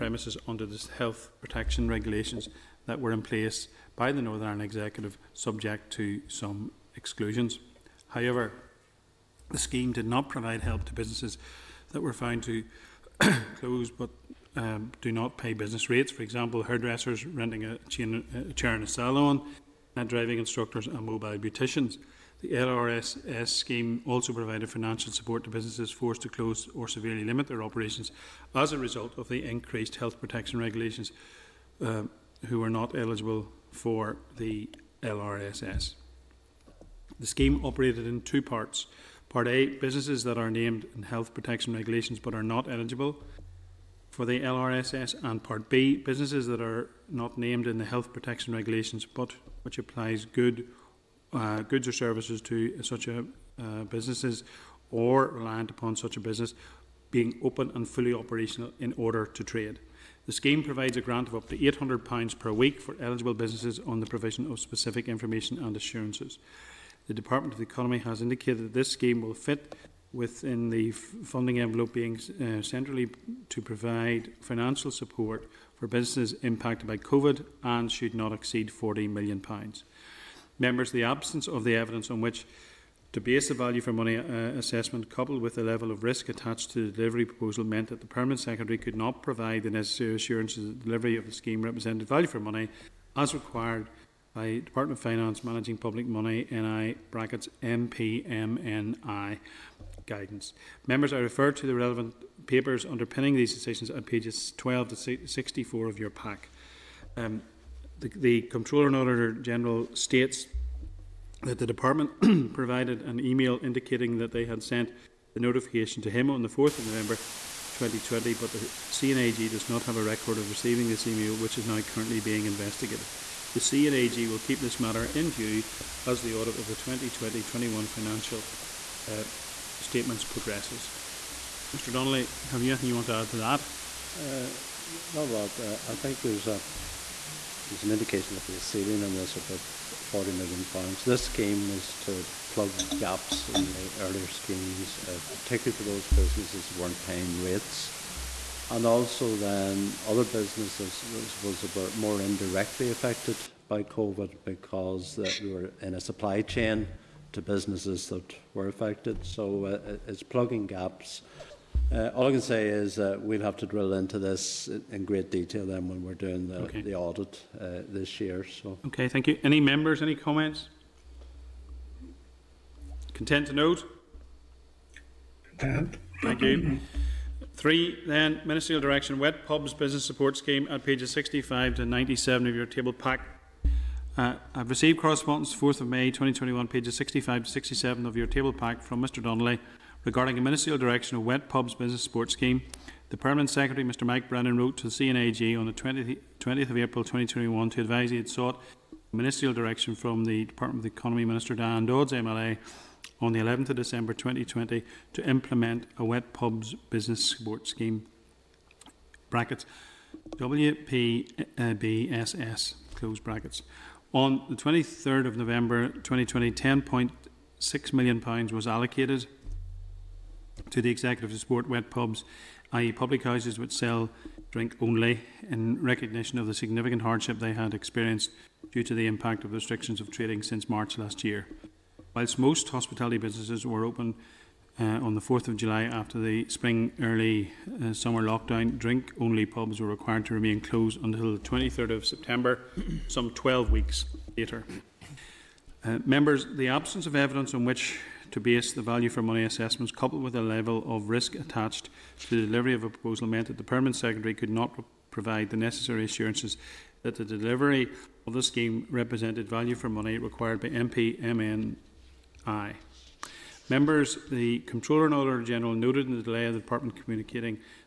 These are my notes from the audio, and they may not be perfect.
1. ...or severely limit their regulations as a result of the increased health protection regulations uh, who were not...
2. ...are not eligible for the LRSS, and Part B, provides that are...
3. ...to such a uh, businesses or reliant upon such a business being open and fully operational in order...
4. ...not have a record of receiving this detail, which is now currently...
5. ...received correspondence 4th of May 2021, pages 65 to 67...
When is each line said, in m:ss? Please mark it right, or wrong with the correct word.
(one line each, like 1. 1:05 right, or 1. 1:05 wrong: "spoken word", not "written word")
1. 0:26 wrong: "operations", not "regulations"
2. 0:42 wrong: "businesses", not "provides"
3. 0:52 right
4. 1:59 wrong: "email", not "detail"
5. 3:04 right.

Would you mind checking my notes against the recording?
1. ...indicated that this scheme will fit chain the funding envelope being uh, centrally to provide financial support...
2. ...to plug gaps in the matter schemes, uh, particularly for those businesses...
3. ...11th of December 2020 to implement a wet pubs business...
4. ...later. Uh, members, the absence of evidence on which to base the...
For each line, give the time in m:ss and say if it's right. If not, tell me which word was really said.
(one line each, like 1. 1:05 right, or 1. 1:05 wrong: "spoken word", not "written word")
1. 1:08 wrong: "within", not "chain"
2. 2:21 wrong: "earlier", not "matter"
3. 3:23 right
4. 4:04 right.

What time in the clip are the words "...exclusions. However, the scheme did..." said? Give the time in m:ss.
0:06.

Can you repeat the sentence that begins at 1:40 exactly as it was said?
Members, I refer to the relevant papers underpinning these decisions at pages 12 to 64 of your pack.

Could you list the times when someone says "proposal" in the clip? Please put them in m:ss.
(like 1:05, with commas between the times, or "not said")
1:27, 4:12.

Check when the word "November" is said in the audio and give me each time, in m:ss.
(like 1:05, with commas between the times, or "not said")
1:56, 3:35.